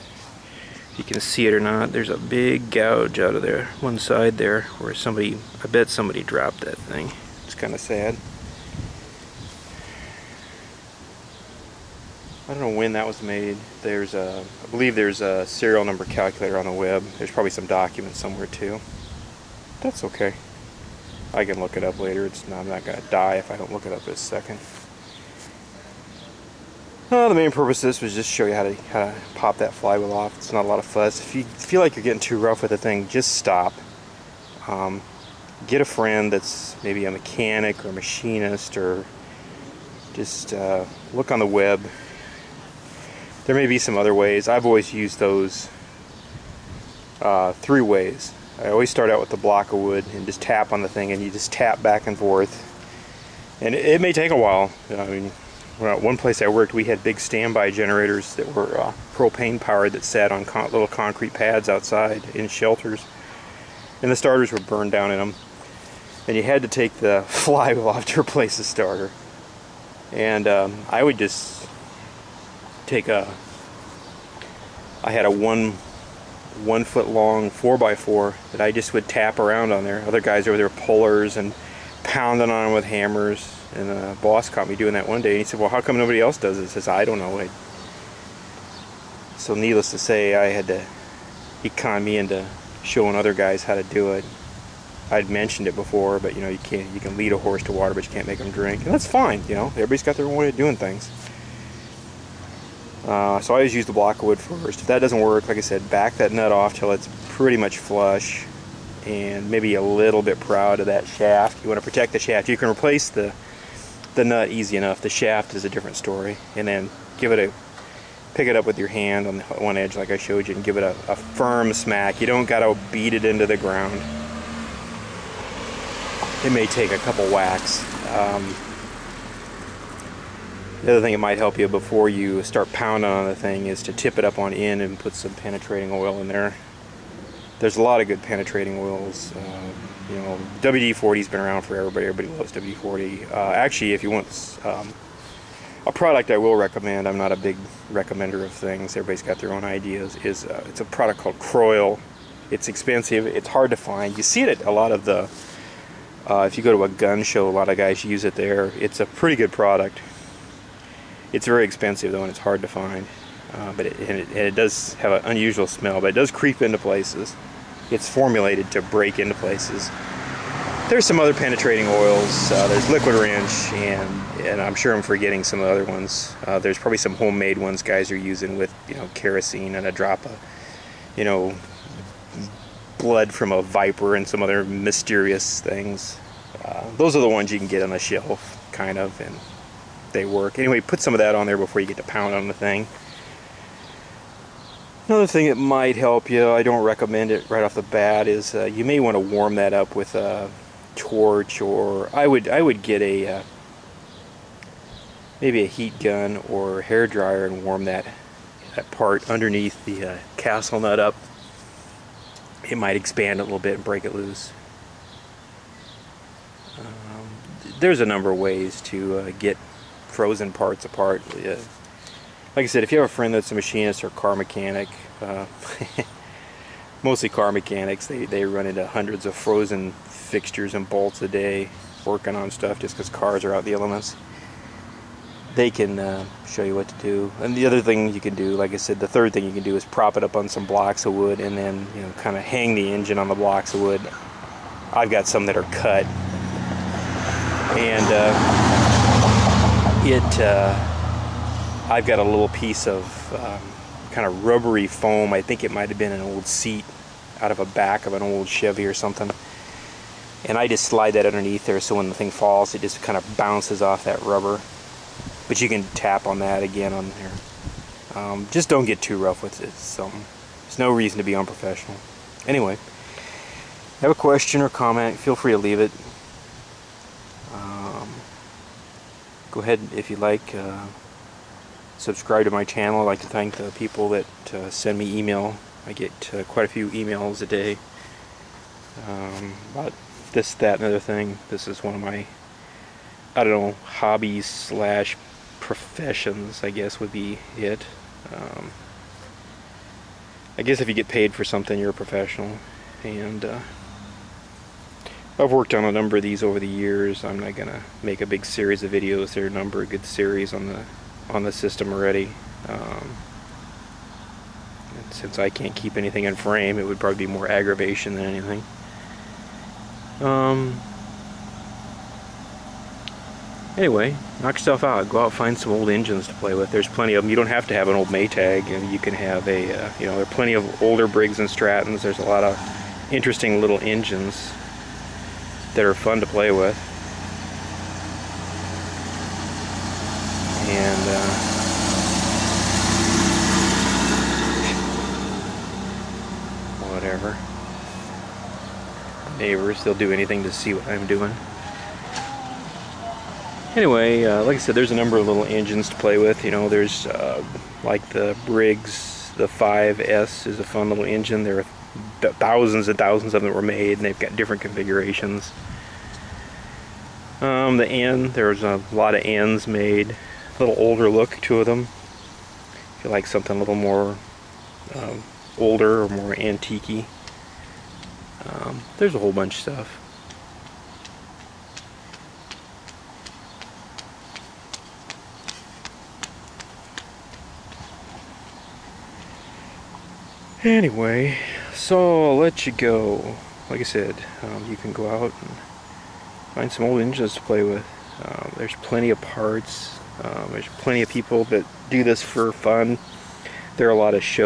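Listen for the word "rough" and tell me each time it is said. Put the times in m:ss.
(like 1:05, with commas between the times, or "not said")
0:32, 4:29.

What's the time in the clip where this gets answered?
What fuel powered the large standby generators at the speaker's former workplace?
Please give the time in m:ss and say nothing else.
0:59.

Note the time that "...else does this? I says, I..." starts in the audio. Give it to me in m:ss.
1:26.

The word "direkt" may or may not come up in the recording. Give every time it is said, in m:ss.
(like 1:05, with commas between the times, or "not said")
not said.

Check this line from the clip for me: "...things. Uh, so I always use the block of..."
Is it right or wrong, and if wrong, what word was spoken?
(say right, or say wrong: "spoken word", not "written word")
right.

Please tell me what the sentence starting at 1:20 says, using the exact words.
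Other guys over there pullers and pounding on them with hammers.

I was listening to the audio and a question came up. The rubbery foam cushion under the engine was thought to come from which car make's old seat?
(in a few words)
Chevy.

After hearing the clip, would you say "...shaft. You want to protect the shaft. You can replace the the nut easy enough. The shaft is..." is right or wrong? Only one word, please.
right.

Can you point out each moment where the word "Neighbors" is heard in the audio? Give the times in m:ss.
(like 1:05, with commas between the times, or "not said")
5:49.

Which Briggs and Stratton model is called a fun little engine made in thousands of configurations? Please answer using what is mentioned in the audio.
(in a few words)
5S.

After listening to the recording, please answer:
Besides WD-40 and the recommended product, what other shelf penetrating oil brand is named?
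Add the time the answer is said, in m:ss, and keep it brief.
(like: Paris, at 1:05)
Liquid Wrench, at 2:52.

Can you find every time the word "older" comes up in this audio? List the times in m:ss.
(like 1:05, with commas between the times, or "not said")
5:30, 6:10, 6:15.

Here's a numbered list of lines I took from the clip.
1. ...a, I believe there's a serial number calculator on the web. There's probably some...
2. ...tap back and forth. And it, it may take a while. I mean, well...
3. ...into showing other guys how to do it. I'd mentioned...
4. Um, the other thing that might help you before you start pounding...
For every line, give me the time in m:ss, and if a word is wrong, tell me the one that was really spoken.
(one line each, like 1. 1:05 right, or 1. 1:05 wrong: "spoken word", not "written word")
1. 0:14 right
2. 0:51 right
3. 1:32 right
4. 2:08 right.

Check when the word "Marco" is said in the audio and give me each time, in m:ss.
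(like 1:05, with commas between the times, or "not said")
not said.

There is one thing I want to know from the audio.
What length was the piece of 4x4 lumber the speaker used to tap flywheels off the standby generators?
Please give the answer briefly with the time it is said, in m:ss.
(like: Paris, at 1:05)
1 foot, at 1:16.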